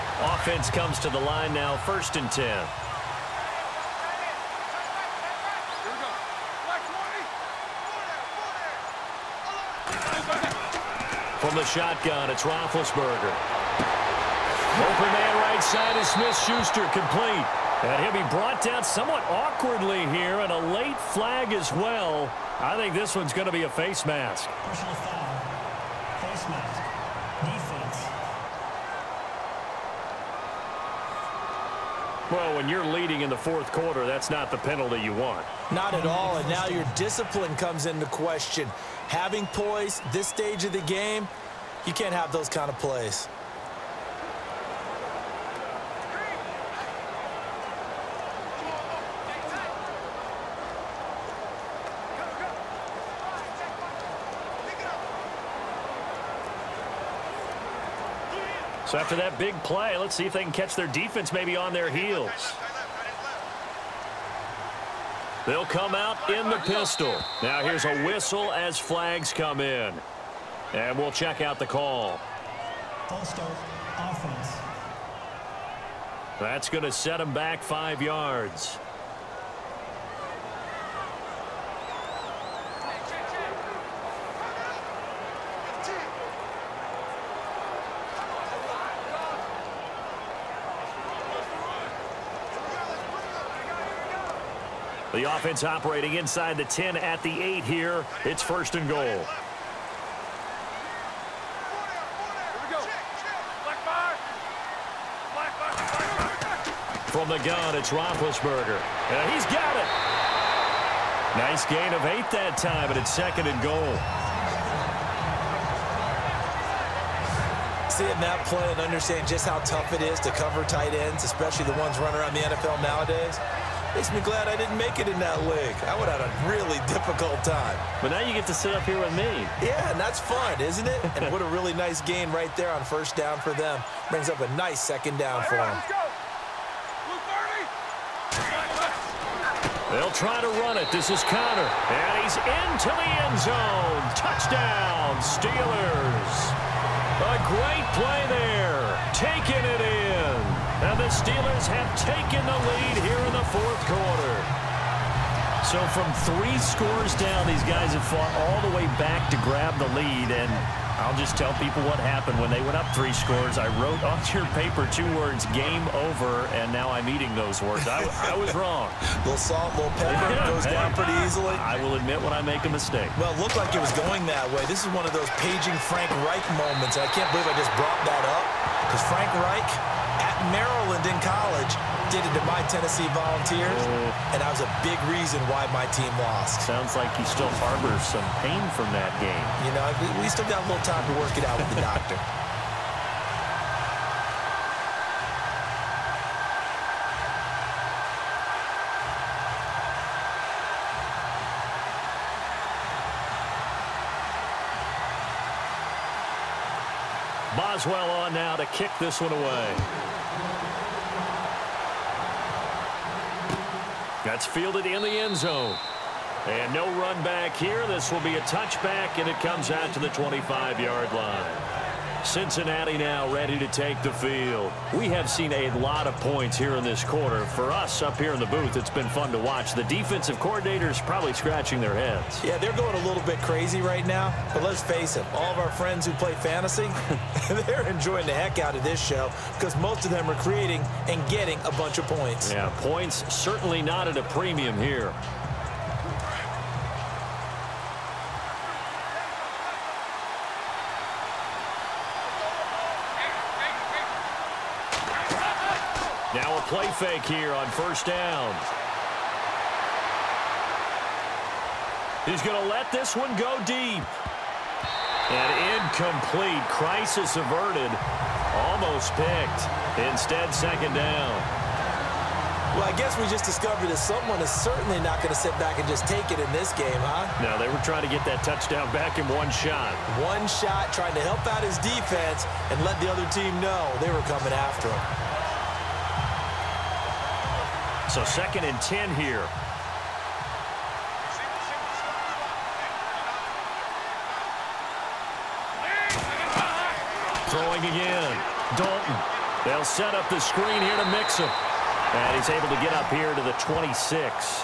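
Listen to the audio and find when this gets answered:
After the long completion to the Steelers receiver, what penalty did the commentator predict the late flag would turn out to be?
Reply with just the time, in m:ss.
0:23.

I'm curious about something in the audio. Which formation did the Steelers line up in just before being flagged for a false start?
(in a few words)
Pistol.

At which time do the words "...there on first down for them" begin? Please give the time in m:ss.
2:12.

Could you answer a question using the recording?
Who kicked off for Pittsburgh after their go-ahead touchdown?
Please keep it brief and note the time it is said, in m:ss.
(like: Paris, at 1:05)
Boswell, at 3:27.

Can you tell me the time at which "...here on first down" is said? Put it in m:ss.
4:17.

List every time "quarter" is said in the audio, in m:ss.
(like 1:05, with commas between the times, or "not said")
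0:33, 2:33, 3:47.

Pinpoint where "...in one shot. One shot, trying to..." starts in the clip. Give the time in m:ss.
4:39.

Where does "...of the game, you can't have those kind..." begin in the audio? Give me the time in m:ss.
0:40.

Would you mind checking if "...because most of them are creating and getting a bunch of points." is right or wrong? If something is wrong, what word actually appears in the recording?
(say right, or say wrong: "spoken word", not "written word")
right.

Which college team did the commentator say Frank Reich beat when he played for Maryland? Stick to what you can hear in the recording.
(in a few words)
Tennessee Volunteers.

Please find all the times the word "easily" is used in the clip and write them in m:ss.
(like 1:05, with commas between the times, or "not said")
2:51.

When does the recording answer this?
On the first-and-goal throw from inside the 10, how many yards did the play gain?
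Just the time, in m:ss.
1:52.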